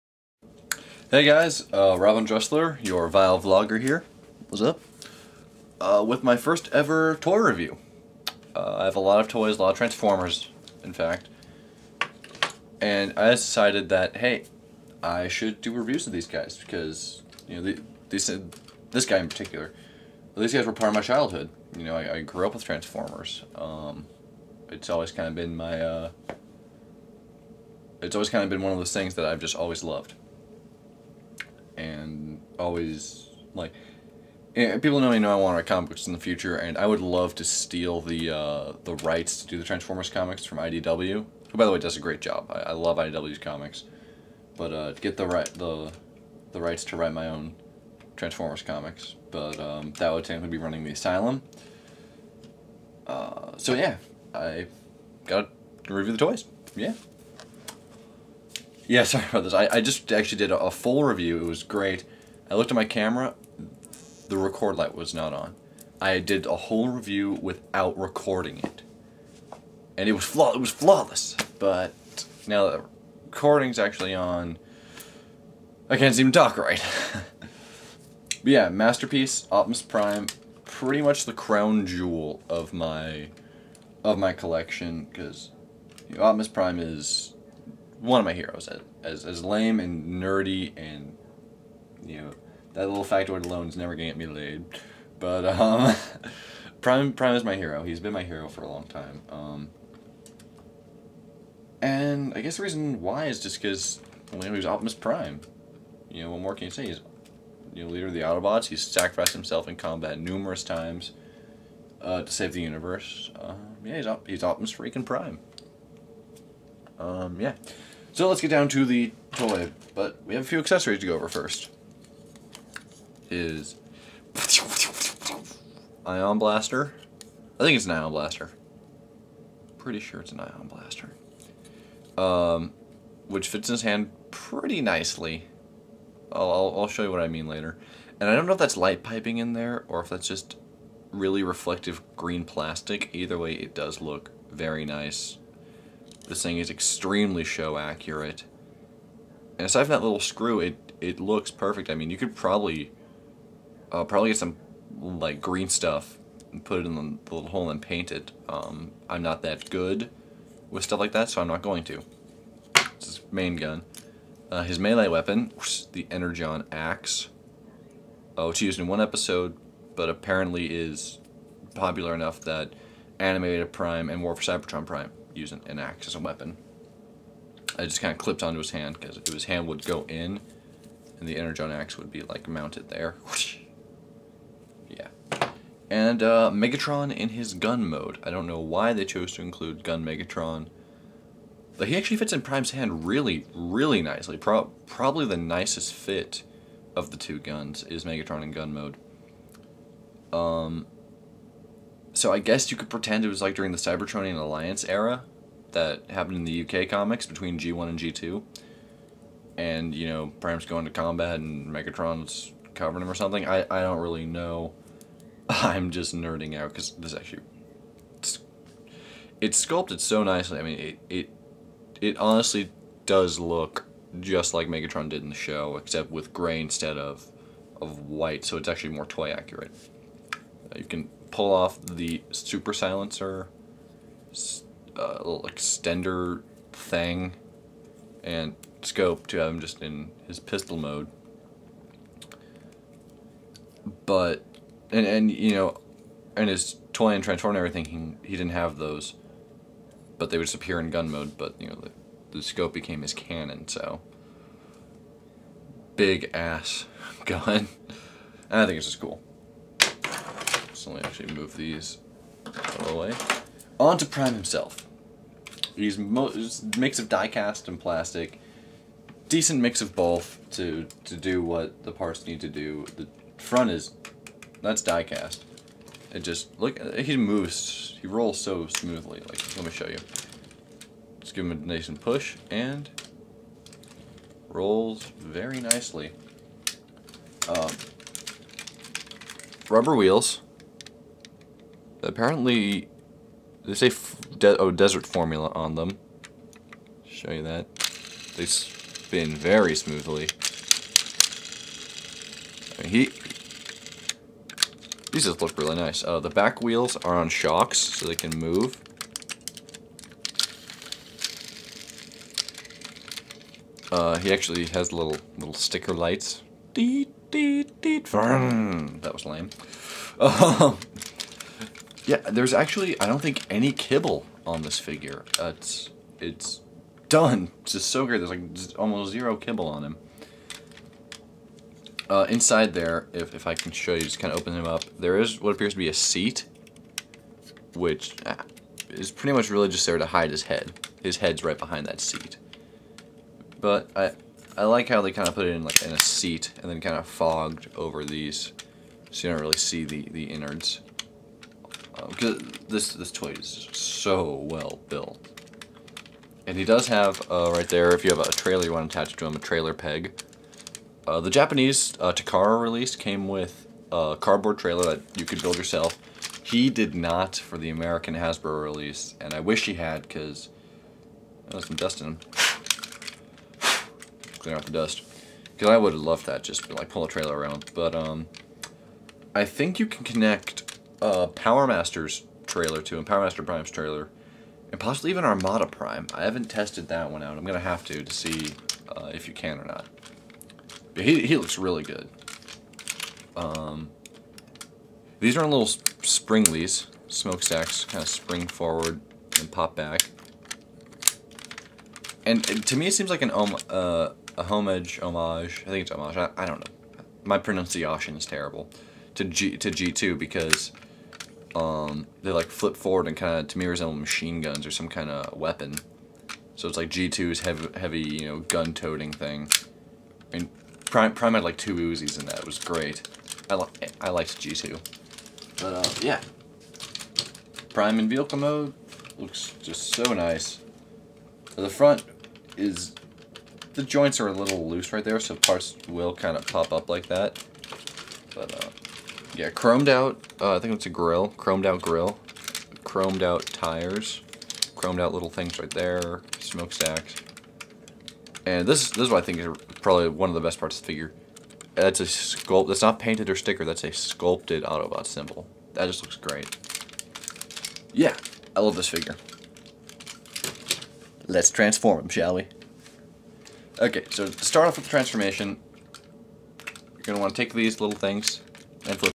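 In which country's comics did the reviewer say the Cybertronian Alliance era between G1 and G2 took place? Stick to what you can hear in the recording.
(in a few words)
UK.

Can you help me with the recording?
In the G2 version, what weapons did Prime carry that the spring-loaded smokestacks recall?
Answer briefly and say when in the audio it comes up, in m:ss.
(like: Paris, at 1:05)
two Uzis, at 7:01.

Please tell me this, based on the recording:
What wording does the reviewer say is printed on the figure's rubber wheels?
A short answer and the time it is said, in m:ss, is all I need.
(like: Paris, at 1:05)
desert formula, at 4:54.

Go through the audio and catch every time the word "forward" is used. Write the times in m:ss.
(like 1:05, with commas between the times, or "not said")
6:38, 6:52.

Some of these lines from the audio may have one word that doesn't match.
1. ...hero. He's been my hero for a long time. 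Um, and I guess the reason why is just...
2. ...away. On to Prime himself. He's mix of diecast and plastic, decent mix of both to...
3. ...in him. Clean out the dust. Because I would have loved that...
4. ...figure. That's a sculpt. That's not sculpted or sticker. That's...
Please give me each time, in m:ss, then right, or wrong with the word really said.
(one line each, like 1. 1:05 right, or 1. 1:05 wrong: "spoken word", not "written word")
1. 1:37 right
2. 4:22 right
3. 6:11 right
4. 7:30 wrong: "painted", not "sculpted".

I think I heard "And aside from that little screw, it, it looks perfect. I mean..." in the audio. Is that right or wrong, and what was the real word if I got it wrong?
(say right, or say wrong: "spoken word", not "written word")
right.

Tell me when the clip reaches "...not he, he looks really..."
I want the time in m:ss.
6:29.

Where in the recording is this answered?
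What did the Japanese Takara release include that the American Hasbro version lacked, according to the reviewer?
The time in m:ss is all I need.
6:04.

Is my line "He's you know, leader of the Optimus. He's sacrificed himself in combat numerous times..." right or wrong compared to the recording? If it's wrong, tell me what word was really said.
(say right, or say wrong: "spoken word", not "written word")
wrong: "Autobots", not "Optimus".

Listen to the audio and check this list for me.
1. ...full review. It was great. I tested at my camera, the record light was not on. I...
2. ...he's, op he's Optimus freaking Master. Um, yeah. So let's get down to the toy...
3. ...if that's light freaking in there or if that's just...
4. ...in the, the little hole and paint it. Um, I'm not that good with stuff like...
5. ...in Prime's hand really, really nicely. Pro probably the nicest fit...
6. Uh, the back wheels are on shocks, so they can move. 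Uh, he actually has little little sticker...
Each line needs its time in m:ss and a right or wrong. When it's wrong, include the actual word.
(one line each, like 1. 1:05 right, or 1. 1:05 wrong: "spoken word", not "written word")
1. 1:00 wrong: "looked", not "tested"
2. 1:53 wrong: "Prime", not "Master"
3. 2:18 wrong: "piping", not "freaking"
4. 2:36 right
5. 3:12 right
6. 5:06 right.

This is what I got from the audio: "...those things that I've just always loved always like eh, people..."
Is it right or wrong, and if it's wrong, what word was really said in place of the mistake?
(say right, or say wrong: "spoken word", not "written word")
right.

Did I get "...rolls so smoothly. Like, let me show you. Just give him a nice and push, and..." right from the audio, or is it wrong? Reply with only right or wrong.
right.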